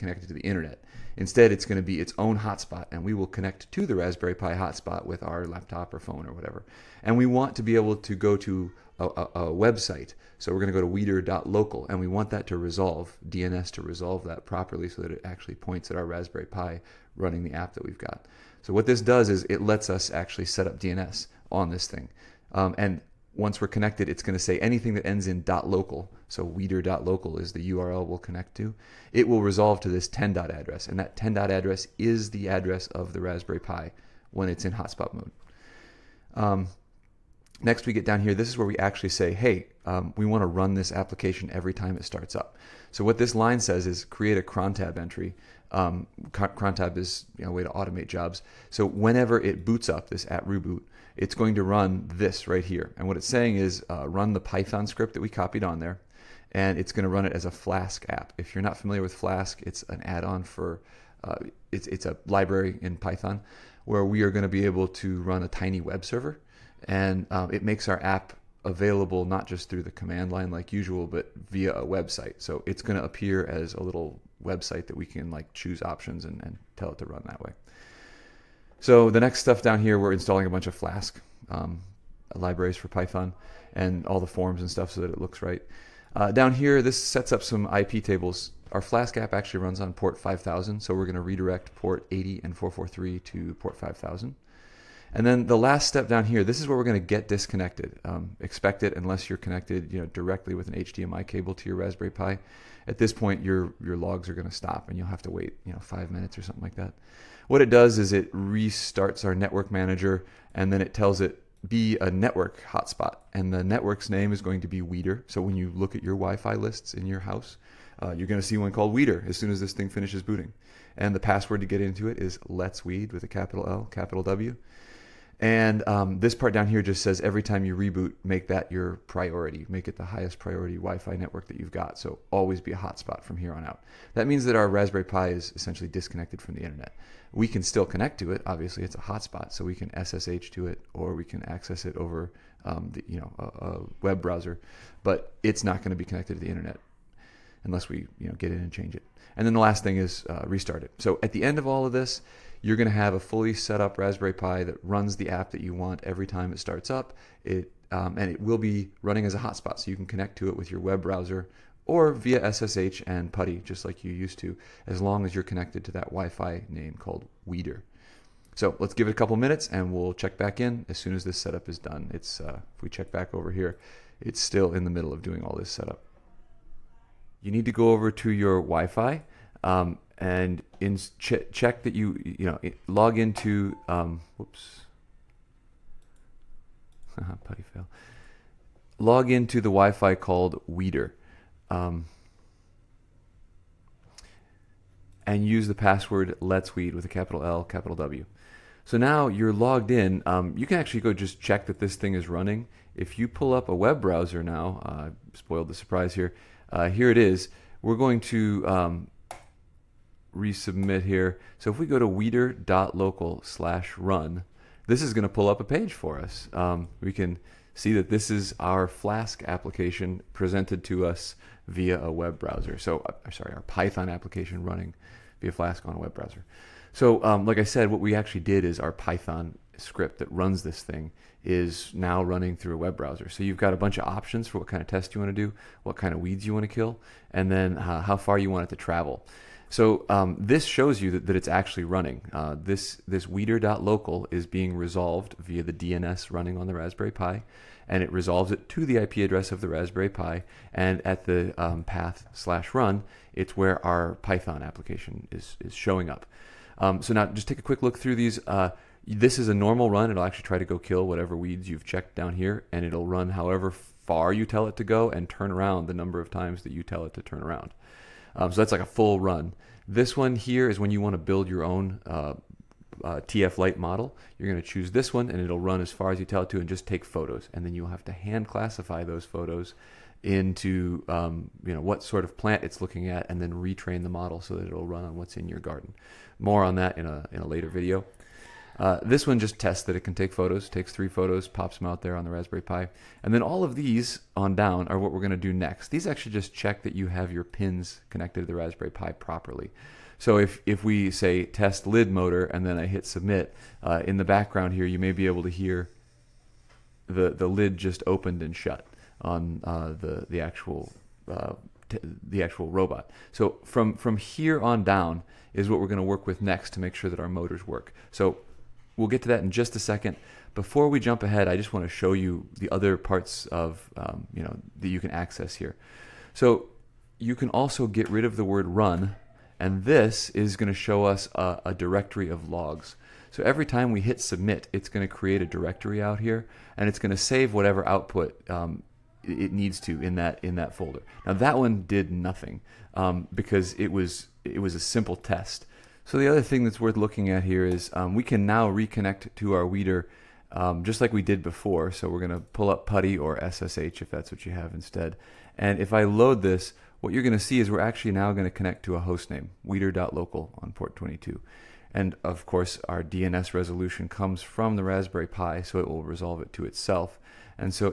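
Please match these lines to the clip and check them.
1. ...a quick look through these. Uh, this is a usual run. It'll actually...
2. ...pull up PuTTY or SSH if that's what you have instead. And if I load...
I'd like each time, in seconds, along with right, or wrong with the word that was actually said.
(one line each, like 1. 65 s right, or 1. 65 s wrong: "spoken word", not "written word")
1. 257 s wrong: "normal", not "usual"
2. 352 s right.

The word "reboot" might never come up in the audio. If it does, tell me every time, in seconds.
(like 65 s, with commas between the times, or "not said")
50 s, 127 s.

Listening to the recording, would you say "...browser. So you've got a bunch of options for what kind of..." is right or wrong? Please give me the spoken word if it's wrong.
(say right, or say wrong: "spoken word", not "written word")
right.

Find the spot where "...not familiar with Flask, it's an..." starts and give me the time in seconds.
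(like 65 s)
58 s.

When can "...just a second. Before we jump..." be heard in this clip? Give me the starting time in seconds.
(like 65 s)
319 s.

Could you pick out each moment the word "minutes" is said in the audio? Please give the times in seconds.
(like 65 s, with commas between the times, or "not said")
106 s, 169 s.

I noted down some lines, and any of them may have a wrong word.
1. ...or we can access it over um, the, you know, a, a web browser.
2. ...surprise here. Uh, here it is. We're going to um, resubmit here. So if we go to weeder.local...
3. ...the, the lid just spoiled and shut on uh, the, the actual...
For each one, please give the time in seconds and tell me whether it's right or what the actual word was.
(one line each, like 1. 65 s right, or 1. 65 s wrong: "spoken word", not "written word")
1. 140 s right
2. 205 s right
3. 307 s wrong: "opened", not "spoiled".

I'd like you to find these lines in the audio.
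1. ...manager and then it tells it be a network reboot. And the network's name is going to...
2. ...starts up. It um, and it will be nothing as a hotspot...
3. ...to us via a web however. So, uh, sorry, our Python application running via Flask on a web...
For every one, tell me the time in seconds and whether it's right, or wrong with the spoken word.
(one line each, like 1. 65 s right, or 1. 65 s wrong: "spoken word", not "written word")
1. 109 s wrong: "hotspot", not "reboot"
2. 156 s wrong: "running", not "nothing"
3. 220 s wrong: "browser", not "however".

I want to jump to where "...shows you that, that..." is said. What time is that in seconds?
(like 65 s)
240 s.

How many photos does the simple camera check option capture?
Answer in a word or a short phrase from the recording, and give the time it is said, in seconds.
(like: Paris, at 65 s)
3, at 290 s.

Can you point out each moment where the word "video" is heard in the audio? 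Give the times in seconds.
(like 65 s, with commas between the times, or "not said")
287 s.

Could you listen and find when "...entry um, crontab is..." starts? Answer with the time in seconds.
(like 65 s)
44 s.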